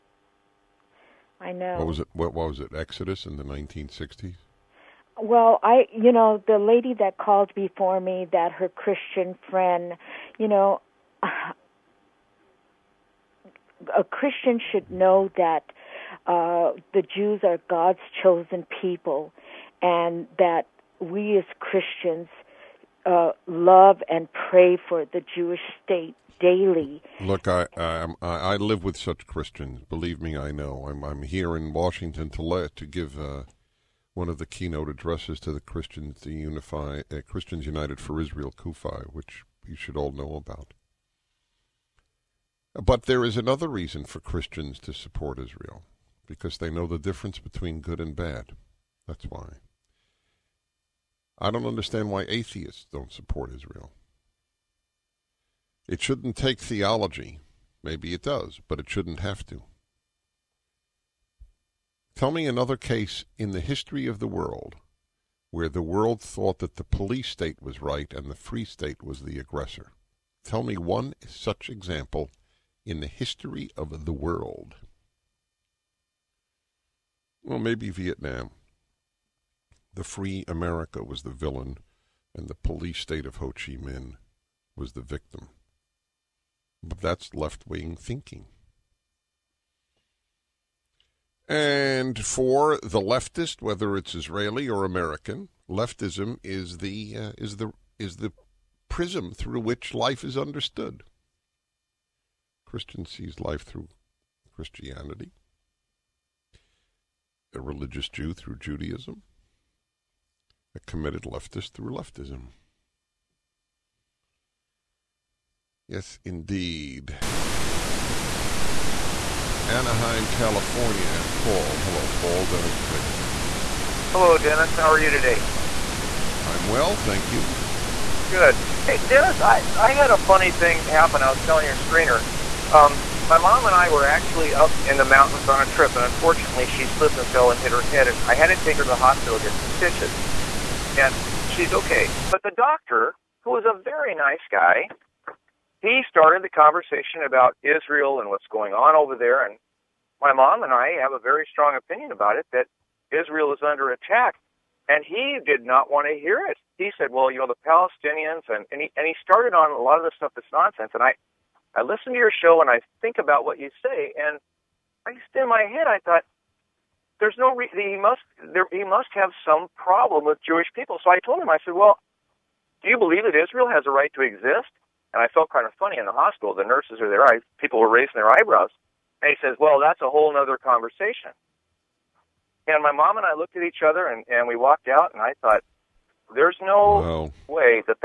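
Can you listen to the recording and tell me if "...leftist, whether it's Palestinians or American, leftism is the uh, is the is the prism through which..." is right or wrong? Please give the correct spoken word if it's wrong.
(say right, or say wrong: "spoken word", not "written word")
wrong: "Israeli", not "Palestinians".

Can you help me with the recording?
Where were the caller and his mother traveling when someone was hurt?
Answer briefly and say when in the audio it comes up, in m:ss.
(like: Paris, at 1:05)
the mountains, at 2:14.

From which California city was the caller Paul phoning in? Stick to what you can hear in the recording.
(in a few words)
Anaheim.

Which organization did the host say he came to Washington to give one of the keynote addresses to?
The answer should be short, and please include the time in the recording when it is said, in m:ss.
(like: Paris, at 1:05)
Christians United for Israel, at 0:37.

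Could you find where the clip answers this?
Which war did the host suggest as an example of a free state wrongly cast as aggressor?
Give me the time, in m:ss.
1:17.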